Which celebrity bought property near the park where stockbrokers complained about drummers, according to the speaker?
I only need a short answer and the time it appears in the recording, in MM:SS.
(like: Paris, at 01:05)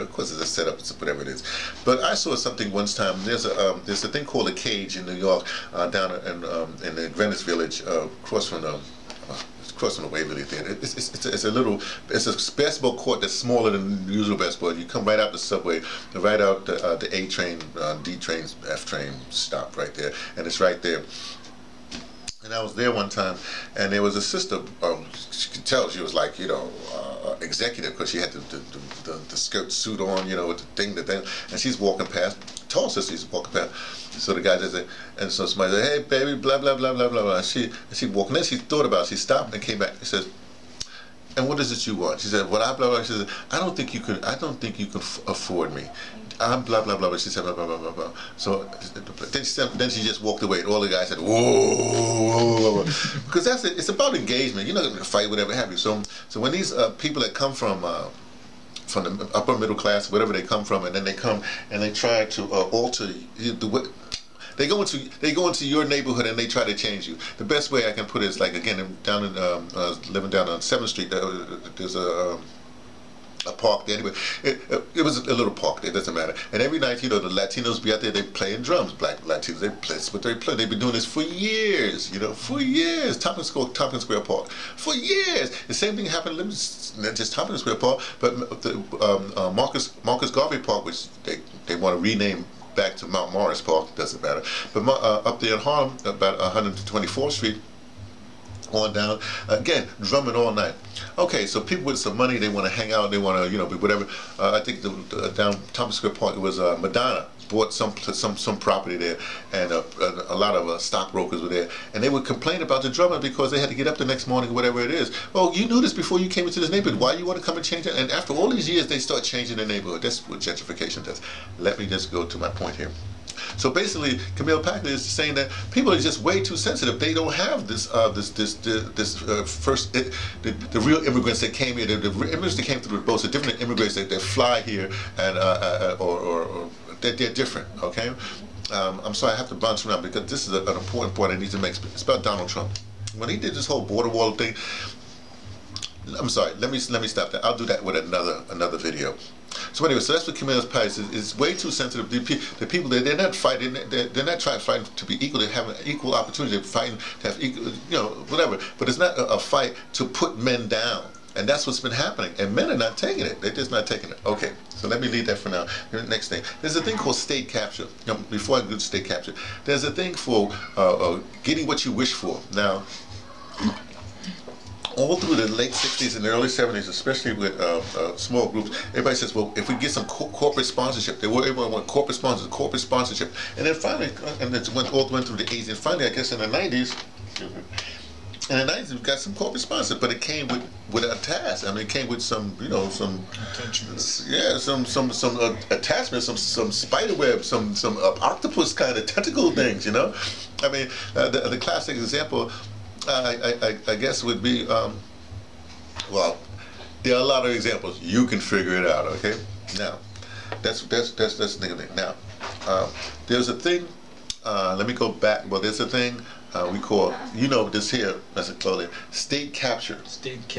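Madonna, at 01:46.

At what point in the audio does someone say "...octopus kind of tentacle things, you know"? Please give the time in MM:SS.
03:18.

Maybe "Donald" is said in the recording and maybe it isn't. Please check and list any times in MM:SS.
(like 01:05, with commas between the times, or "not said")
02:22.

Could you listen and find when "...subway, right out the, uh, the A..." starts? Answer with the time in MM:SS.
00:15.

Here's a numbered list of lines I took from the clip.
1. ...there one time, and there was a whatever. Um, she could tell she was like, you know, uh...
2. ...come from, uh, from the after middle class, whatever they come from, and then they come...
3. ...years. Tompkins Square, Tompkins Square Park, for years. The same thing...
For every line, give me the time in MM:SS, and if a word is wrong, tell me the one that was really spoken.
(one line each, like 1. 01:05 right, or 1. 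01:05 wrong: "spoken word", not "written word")
1. 00:22 wrong: "sister", not "whatever"
2. 00:57 wrong: "upper", not "after"
3. 01:22 right.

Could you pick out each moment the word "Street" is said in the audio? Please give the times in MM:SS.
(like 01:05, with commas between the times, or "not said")
01:10, 01:37.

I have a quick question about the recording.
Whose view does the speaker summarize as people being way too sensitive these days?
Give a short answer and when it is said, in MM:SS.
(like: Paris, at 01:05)
Camille Paglia, at 02:04.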